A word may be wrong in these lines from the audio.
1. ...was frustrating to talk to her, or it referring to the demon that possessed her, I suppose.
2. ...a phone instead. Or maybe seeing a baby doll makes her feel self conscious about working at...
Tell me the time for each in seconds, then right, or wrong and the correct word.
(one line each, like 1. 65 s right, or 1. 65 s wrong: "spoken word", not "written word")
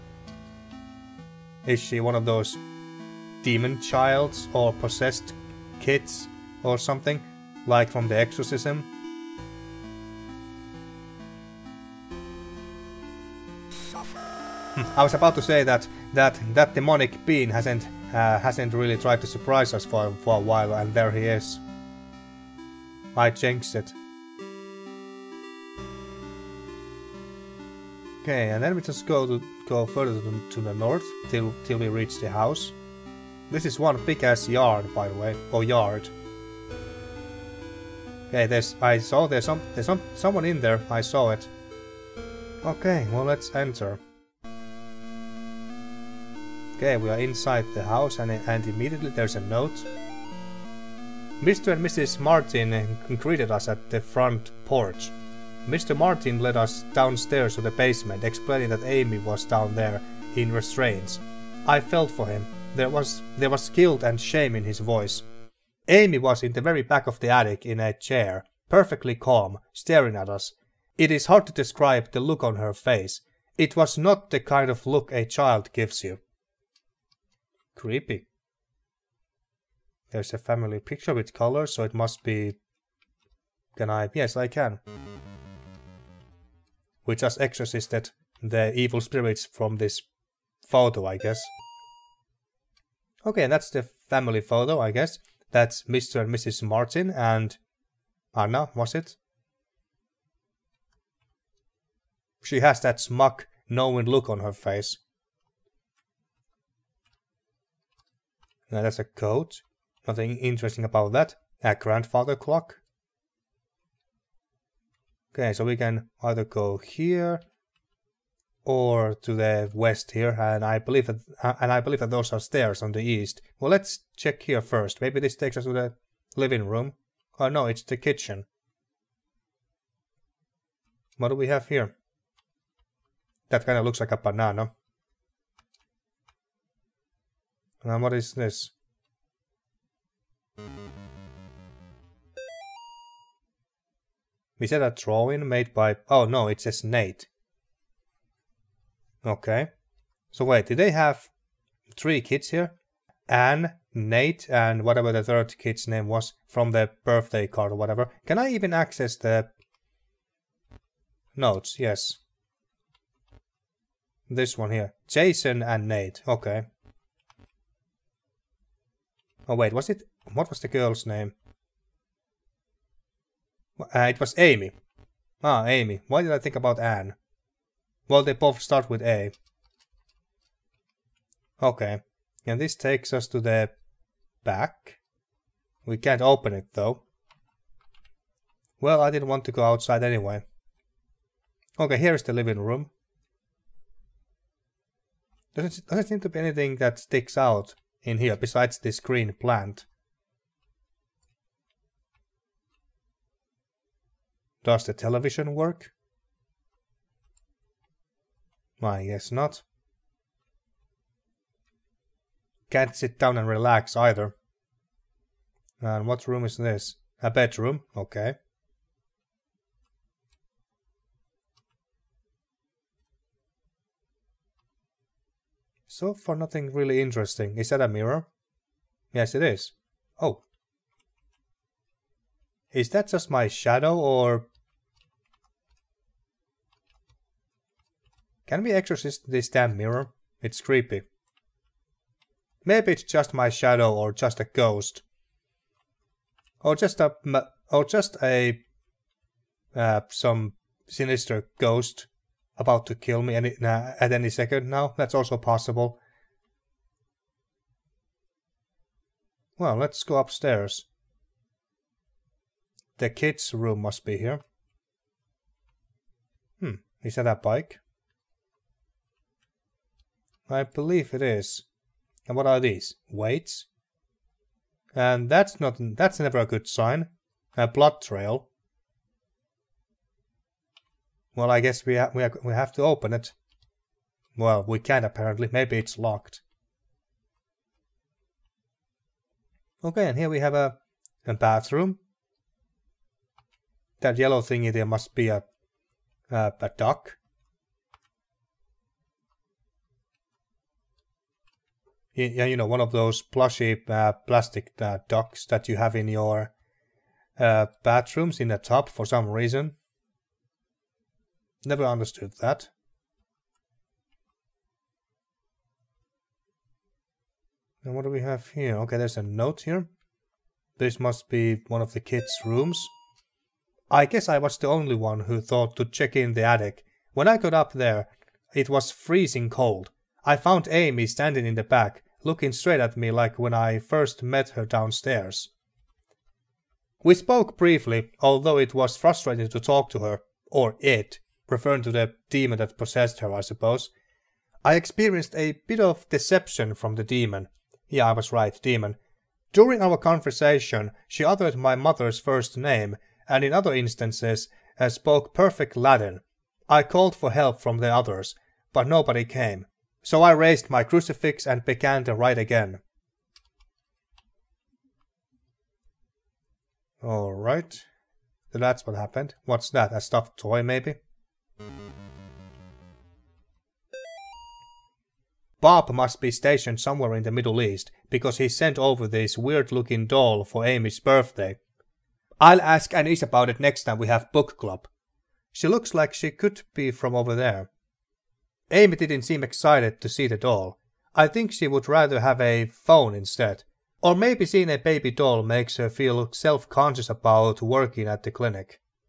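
1. 338 s right
2. 392 s right.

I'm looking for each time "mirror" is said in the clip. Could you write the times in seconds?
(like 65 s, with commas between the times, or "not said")
227 s, 239 s.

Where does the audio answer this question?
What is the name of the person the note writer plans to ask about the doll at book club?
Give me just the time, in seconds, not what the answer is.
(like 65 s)
382 s.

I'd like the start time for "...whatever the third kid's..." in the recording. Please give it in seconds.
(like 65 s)
154 s.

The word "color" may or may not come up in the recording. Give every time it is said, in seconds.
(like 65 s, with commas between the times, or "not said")
81 s.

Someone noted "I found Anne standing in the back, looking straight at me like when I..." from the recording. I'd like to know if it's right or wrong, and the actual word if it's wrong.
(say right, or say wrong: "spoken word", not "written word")
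wrong: "Amy", not "Anne".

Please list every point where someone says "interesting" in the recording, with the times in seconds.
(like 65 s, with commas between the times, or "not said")
110 s, 226 s.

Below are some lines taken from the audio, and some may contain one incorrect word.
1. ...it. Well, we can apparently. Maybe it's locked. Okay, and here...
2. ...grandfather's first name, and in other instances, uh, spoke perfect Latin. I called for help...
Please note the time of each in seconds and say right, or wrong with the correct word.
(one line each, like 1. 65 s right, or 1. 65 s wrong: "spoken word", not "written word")
1. 283 s right
2. 351 s wrong: "mother", not "grandfather".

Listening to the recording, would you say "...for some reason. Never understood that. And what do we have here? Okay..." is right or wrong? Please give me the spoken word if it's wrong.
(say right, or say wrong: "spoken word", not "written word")
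right.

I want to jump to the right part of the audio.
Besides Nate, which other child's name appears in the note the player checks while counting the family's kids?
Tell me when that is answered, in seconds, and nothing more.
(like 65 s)
165 s.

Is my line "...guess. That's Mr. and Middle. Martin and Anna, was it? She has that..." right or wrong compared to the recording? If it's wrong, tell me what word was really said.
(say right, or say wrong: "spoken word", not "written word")
wrong: "Mrs", not "Middle".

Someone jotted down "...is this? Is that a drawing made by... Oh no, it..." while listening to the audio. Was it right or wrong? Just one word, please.
right.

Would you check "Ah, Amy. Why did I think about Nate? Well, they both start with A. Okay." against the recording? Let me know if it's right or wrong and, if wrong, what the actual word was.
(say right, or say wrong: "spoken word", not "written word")
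wrong: "Anne", not "Nate".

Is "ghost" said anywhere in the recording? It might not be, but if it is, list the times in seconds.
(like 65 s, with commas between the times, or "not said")
244 s, 251 s.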